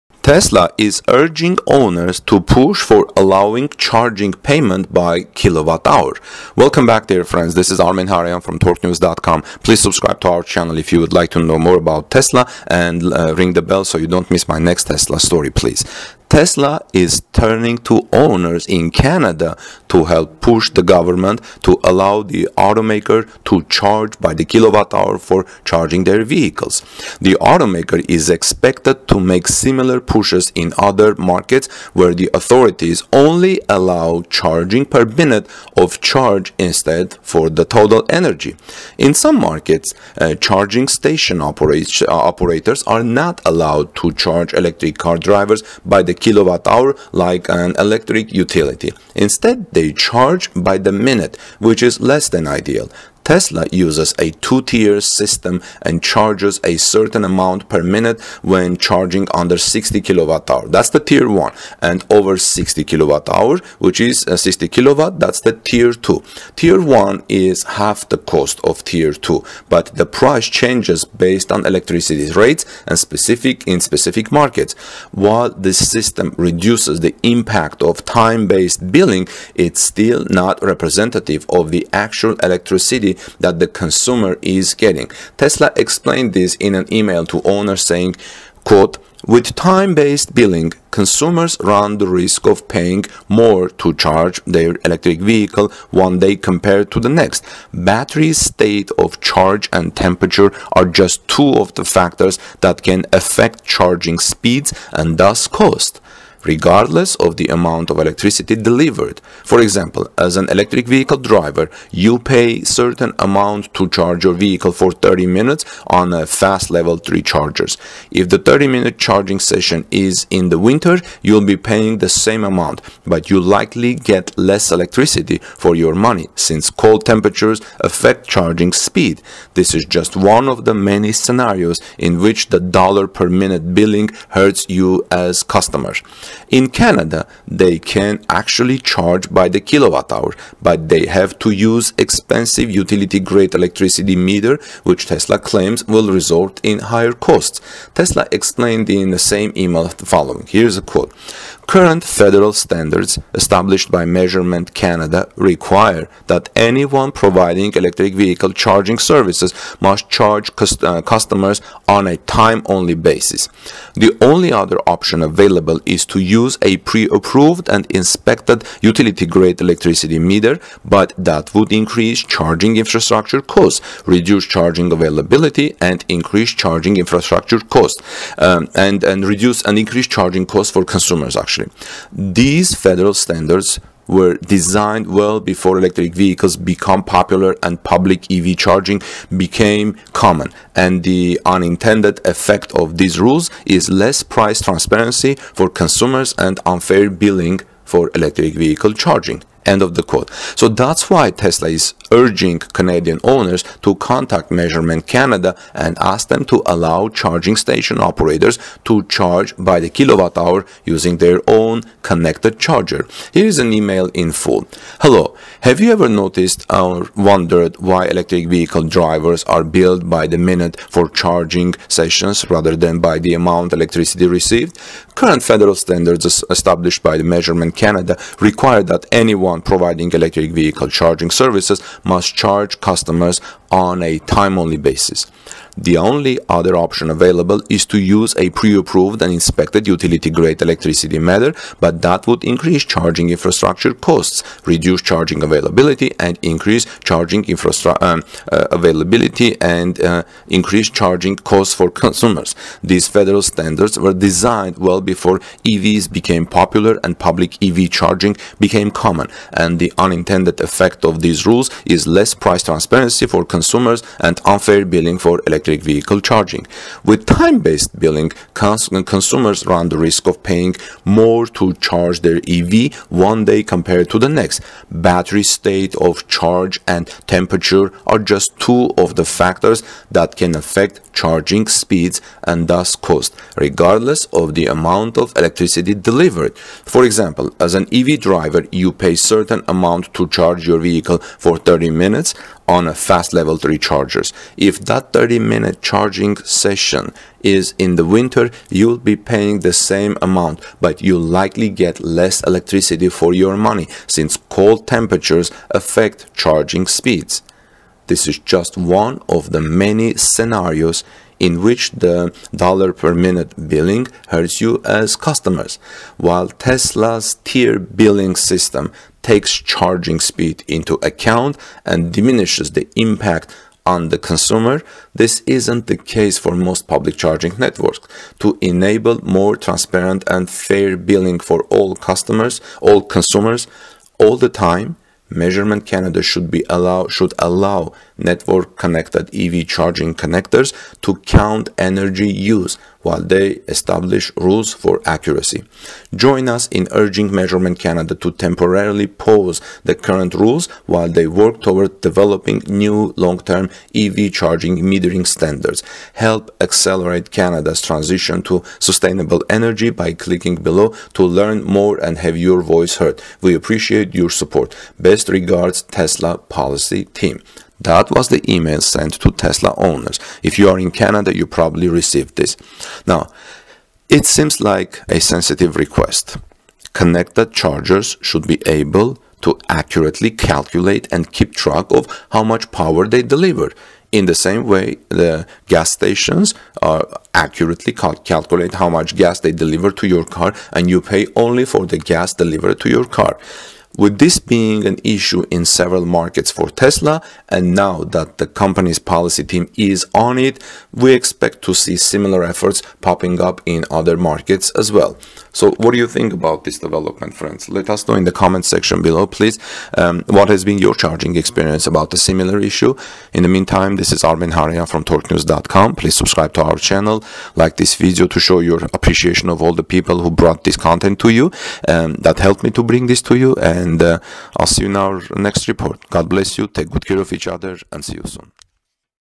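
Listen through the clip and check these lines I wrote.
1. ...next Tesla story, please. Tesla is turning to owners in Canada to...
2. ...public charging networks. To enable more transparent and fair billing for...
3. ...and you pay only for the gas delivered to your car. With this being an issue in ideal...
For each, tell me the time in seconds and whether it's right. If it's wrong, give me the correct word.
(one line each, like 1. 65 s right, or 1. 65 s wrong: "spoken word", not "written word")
1. 14 s right
2. 326 s right
3. 390 s wrong: "several", not "ideal".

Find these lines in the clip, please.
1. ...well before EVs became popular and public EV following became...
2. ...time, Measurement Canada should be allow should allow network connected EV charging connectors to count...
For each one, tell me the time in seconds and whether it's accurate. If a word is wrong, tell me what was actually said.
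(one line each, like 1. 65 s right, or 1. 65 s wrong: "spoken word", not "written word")
1. 254 s wrong: "charging", not "following"
2. 334 s right.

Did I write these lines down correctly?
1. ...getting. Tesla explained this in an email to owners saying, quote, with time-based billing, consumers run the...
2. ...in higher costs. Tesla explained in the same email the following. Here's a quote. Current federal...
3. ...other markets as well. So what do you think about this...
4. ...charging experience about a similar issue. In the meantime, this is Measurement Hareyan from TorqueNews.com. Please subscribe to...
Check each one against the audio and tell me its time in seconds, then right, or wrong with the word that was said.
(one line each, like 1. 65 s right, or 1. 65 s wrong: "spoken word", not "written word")
1. 84 s right
2. 146 s right
3. 403 s right
4. 410 s wrong: "Armen", not "Measurement".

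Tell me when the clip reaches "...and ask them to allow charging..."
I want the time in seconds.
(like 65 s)
205 s.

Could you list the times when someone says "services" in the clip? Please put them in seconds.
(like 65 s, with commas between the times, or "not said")
158 s, 231 s.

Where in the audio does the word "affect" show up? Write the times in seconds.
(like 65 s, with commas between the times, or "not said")
103 s, 127 s, 280 s, 305 s.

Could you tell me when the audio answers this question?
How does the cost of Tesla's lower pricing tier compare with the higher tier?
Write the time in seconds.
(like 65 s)
67 s.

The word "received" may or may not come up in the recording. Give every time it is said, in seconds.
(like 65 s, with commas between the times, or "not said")
224 s, 371 s.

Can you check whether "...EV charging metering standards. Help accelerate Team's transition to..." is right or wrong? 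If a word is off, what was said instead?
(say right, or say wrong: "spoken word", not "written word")
wrong: "Canada", not "Team".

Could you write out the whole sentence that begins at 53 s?
Tesla uses a two-tier system and charges a certain amount per minute when charging under 60 kilowatt hour.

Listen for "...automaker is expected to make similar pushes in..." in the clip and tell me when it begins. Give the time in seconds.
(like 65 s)
27 s.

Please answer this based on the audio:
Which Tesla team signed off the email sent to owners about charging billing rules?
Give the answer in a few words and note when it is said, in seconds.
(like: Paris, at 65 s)
Tesla Policy Team, at 365 s.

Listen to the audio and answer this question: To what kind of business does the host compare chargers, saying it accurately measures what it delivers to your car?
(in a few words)
gas stations.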